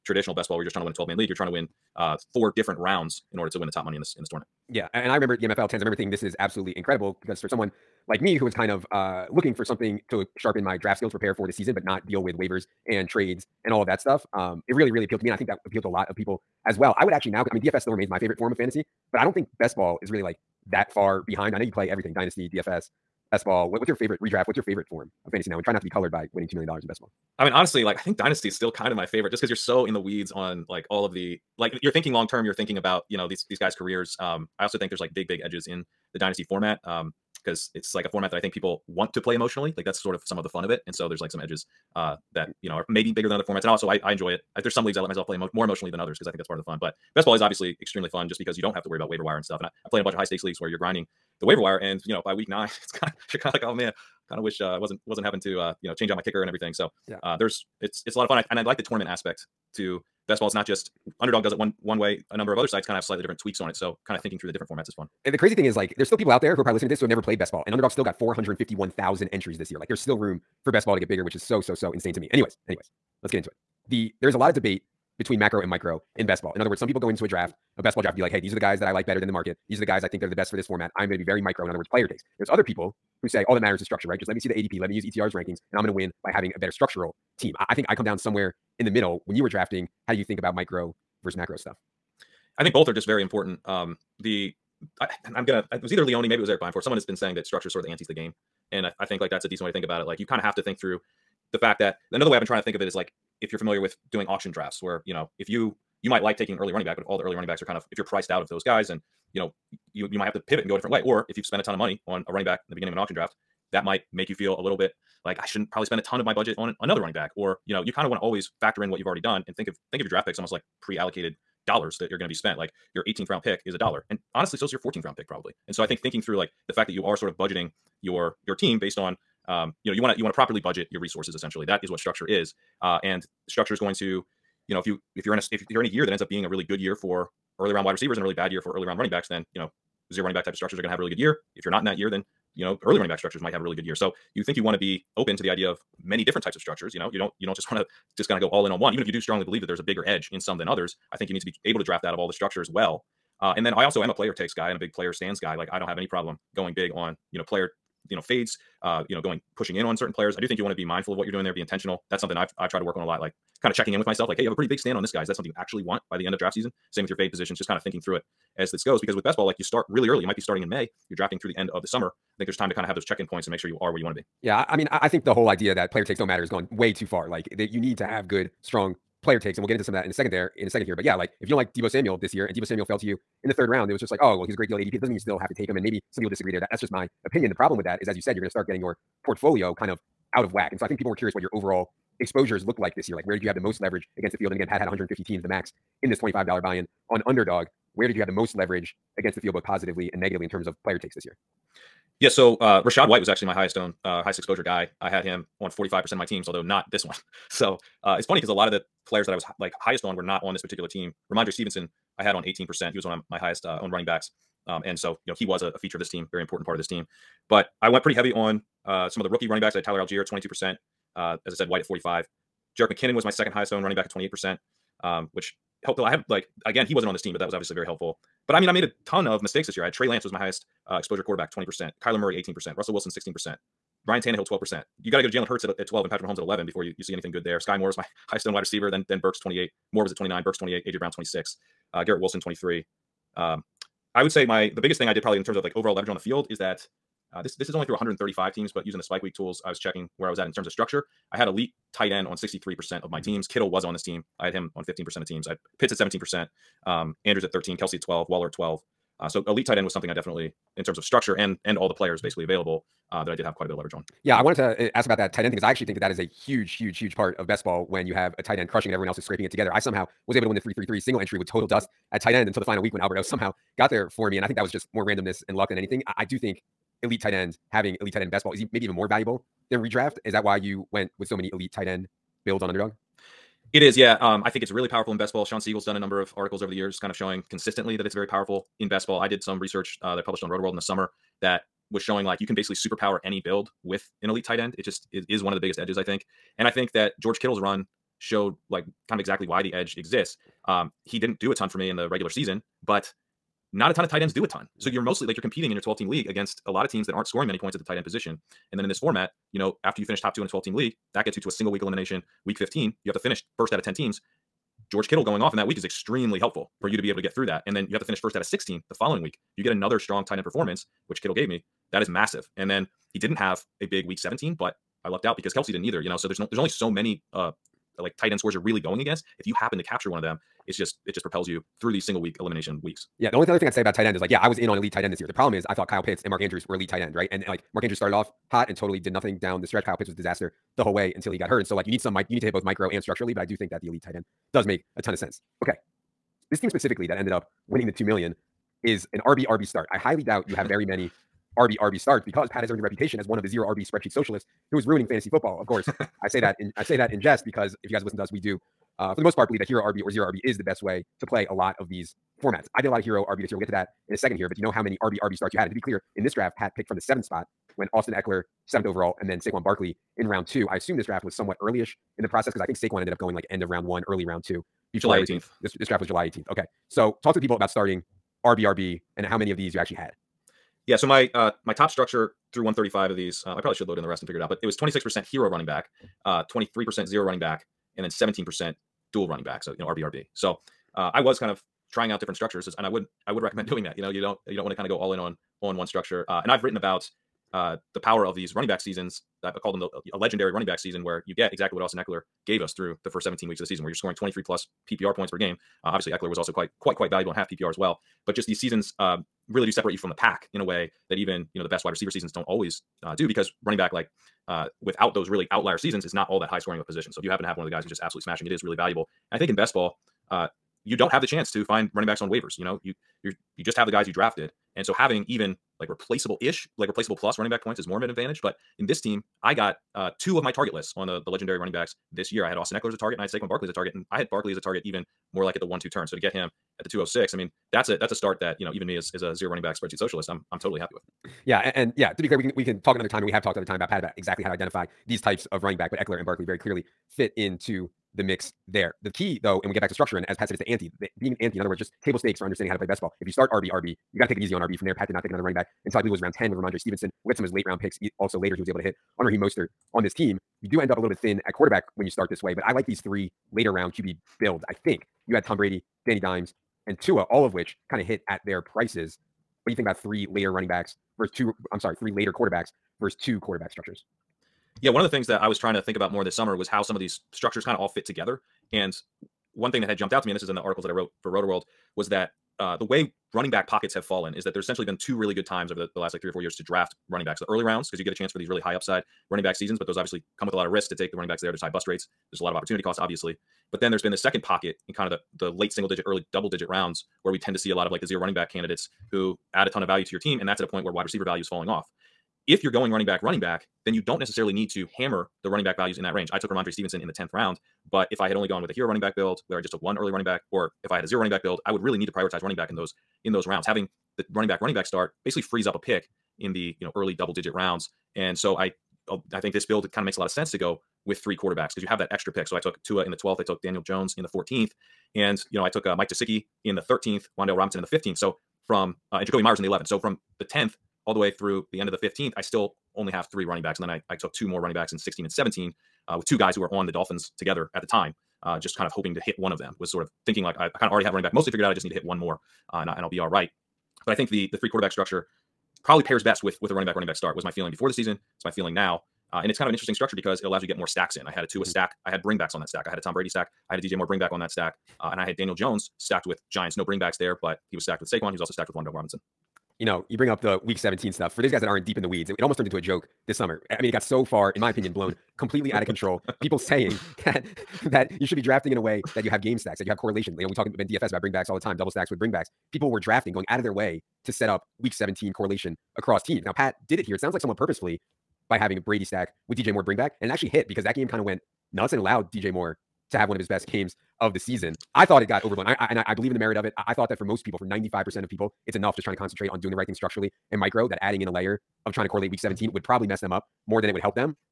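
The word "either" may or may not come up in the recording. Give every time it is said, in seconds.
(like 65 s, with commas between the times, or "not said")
95 s, 325 s.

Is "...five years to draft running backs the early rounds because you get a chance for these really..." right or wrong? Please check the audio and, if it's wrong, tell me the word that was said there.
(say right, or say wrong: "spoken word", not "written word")
wrong: "four", not "five".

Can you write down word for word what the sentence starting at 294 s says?
It just is, is one of the biggest edges, I think.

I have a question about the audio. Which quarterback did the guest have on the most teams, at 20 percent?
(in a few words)
Trey Lance.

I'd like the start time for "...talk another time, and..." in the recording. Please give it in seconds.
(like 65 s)
442 s.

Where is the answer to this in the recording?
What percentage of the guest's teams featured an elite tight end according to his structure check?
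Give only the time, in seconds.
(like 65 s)
252 s.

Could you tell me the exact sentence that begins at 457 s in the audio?
We'll get some of his late round picks.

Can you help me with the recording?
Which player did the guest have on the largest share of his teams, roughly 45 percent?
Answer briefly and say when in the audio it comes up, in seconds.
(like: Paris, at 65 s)
Rachaad White, at 202 s.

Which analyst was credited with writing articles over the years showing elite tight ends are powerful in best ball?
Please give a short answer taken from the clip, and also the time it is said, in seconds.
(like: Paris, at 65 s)
Shawn Siegele, at 285 s.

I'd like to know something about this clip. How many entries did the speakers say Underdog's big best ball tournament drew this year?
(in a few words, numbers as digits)
451,000.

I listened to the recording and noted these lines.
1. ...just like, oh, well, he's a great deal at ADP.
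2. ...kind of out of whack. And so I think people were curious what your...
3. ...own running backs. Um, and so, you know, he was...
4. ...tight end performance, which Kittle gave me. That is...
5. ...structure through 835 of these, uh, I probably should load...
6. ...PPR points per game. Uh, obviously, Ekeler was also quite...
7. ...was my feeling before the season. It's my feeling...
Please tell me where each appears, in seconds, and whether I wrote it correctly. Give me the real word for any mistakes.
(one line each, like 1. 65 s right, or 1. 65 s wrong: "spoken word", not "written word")
1. 183 s right
2. 189 s right
3. 213 s right
4. 320 s right
5. 381 s wrong: "135", not "835"
6. 404 s right
7. 547 s right.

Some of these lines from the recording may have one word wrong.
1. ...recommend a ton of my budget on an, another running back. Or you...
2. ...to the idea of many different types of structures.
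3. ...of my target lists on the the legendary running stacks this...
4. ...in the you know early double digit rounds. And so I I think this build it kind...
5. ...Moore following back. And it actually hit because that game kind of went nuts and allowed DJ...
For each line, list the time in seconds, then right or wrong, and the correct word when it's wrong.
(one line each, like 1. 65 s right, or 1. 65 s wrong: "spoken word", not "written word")
1. 115 s wrong: "spend", not "recommend"
2. 145 s right
3. 430 s wrong: "backs", not "stacks"
4. 516 s right
5. 579 s wrong: "bring", not "following".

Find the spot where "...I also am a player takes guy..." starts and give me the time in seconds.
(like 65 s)
153 s.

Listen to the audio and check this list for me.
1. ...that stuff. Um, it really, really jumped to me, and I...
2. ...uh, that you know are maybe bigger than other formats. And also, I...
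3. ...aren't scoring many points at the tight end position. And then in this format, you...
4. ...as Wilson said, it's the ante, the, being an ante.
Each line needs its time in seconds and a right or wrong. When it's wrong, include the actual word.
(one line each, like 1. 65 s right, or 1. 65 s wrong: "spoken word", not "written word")
1. 13 s wrong: "appealed", not "jumped"
2. 41 s right
3. 307 s right
4. 450 s wrong: "Pat", not "Wilson".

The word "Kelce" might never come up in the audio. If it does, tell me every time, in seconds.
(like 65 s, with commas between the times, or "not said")
257 s, 325 s.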